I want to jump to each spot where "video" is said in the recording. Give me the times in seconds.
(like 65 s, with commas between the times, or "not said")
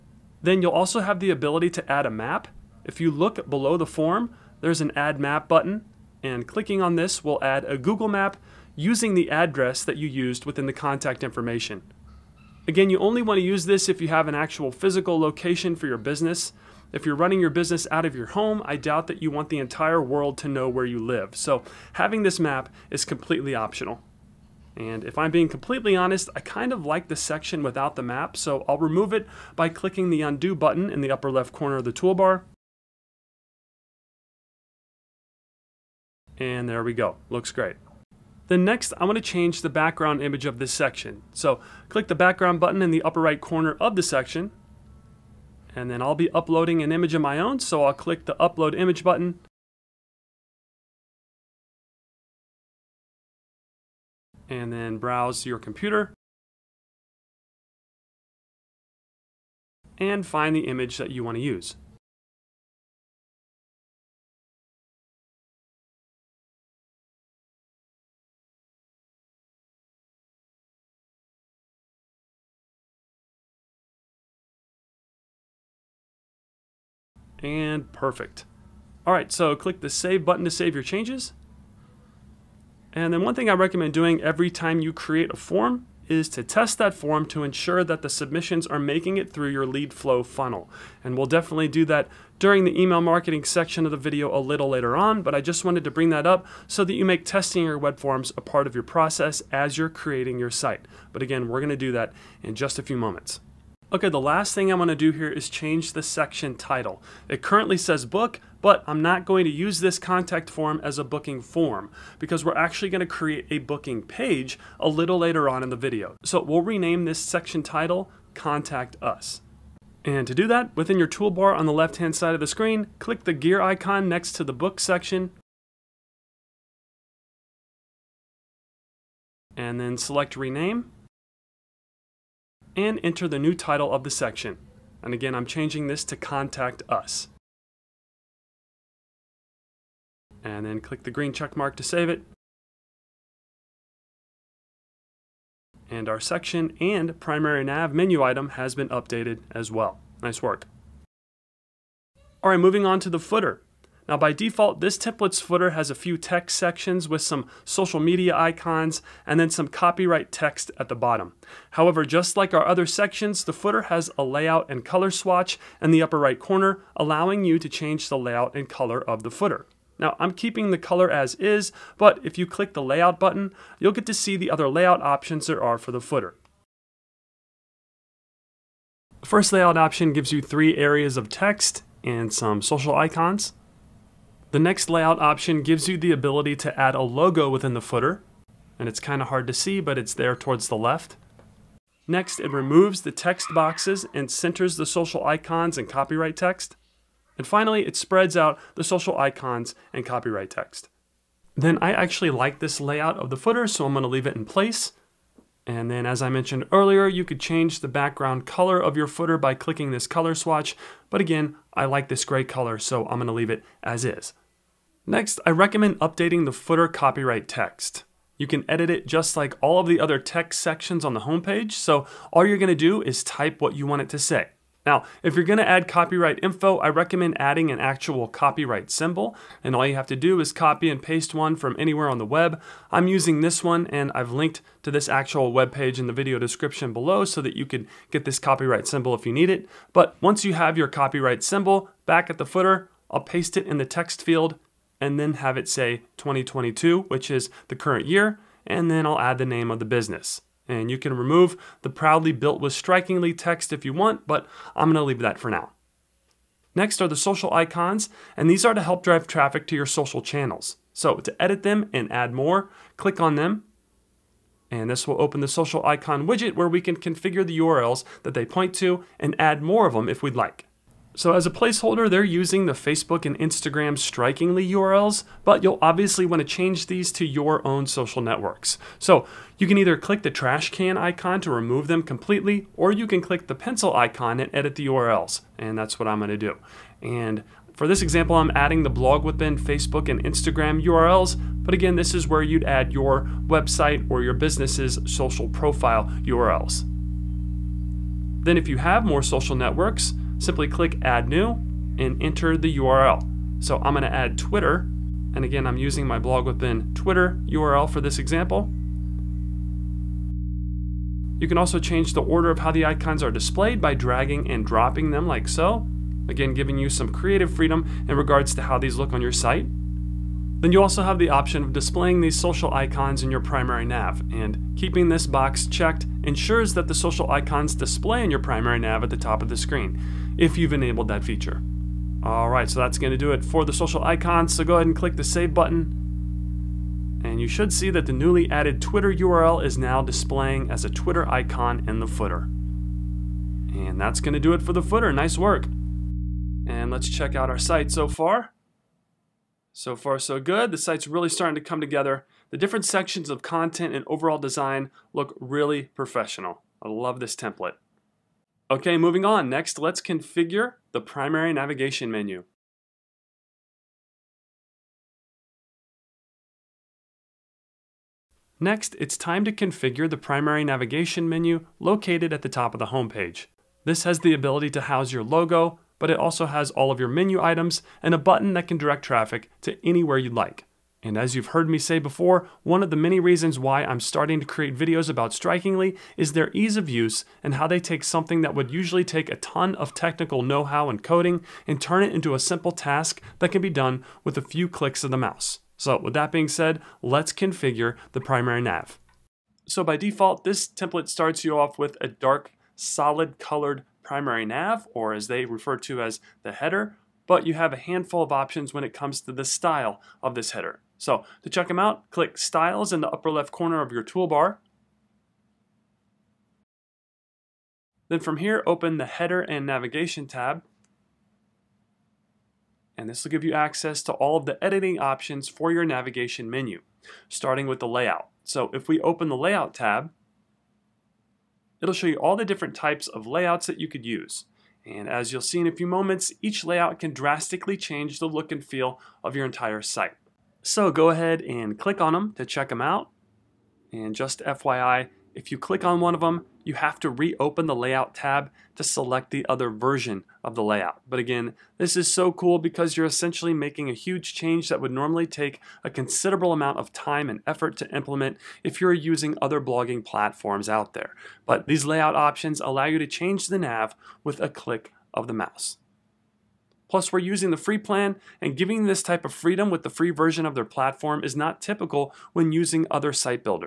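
93 s, 115 s, 236 s, 384 s.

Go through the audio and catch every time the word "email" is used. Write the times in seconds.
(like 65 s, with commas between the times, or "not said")
92 s.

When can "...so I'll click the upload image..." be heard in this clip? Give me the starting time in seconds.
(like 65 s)
47 s.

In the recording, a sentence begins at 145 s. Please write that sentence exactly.
And our section and primary nav menu item has been updated as well.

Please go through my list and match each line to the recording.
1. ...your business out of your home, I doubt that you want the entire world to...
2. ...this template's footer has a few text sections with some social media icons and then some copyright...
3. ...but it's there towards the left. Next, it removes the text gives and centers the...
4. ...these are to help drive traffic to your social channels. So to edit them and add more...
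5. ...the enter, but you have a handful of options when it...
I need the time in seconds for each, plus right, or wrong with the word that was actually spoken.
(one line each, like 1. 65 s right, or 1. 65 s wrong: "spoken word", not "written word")
1. 17 s right
2. 154 s right
3. 189 s wrong: "boxes", not "gives"
4. 258 s right
5. 406 s wrong: "header", not "enter".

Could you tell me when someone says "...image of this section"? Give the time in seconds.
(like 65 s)
40 s.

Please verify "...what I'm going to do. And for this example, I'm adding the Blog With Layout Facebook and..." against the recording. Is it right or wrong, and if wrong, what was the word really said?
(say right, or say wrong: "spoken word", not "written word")
wrong: "Ben", not "Layout".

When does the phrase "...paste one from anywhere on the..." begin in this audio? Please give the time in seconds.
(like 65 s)
231 s.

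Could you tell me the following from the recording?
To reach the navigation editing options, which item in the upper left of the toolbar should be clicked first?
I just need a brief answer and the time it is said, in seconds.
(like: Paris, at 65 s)
Styles, at 412 s.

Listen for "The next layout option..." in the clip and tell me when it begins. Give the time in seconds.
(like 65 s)
184 s.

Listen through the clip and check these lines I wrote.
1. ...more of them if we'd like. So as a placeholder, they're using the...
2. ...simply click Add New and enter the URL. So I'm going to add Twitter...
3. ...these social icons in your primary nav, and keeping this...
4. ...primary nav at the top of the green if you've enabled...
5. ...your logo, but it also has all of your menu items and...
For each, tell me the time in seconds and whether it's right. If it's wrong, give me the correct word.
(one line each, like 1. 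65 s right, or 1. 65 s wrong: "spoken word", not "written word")
1. 269 s right
2. 300 s right
3. 322 s right
4. 328 s wrong: "screen", not "green"
5. 375 s right.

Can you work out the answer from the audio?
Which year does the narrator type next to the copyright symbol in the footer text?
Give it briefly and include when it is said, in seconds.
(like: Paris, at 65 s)
2022, at 246 s.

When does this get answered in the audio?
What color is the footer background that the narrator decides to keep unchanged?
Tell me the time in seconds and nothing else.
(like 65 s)
212 s.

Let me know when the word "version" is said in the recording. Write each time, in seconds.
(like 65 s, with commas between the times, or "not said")
449 s, 470 s.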